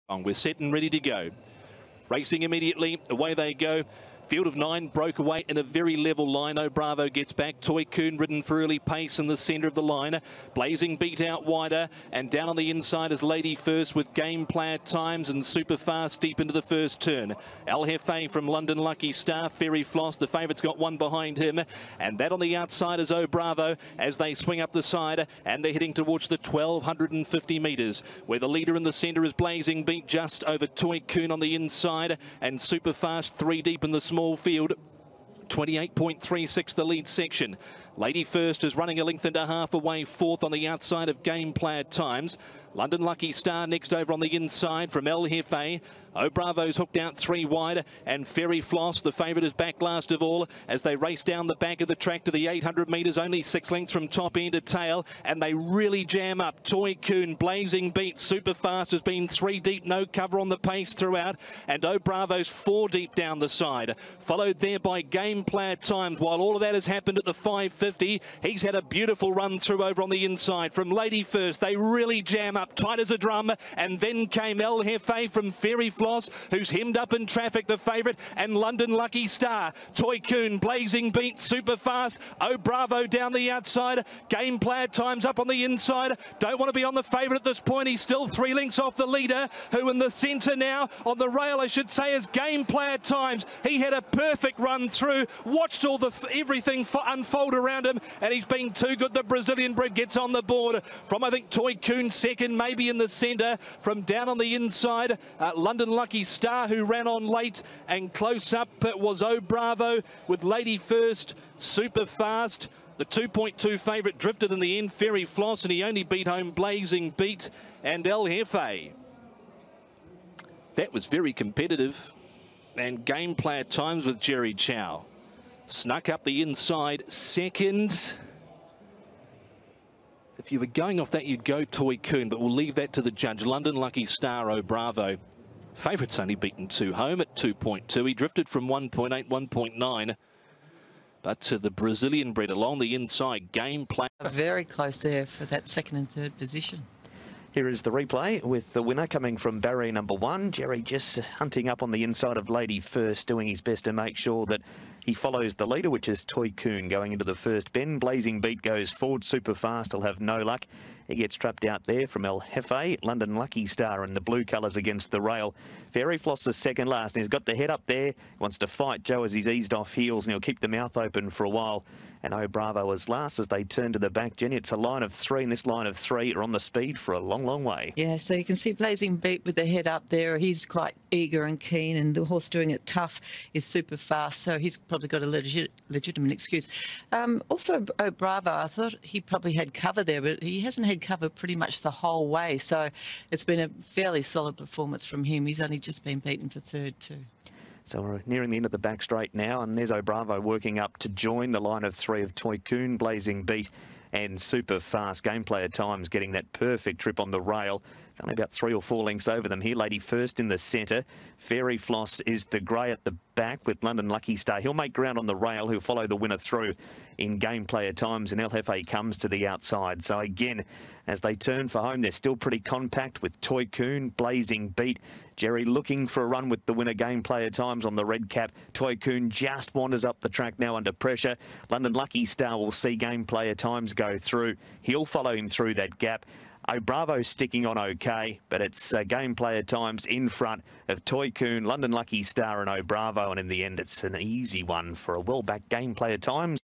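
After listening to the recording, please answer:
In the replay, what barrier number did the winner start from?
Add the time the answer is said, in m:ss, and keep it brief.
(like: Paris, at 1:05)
1, at 2:29.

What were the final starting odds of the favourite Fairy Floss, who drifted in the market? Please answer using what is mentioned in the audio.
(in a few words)
2.2.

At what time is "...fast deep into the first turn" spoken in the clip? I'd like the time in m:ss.
0:15.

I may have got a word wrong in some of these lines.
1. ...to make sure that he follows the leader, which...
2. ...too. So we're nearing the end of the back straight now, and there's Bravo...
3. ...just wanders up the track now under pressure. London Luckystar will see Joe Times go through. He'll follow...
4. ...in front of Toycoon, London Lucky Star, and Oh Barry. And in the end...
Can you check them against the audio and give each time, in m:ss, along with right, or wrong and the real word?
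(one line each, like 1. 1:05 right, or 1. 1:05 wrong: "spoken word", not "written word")
1. 2:33 right
2. 3:16 right
3. 3:49 wrong: "Gameplayer", not "Joe"
4. 4:00 wrong: "Bravo", not "Barry".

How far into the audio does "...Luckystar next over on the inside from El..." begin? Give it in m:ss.
0:43.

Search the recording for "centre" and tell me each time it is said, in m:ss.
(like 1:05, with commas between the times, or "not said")
0:09, 0:28, 1:30, 1:43, 3:30.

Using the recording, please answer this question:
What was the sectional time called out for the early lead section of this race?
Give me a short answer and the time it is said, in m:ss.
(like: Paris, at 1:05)
28.36, at 0:35.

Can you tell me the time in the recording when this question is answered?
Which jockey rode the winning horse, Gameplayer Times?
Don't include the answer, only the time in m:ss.
2:04.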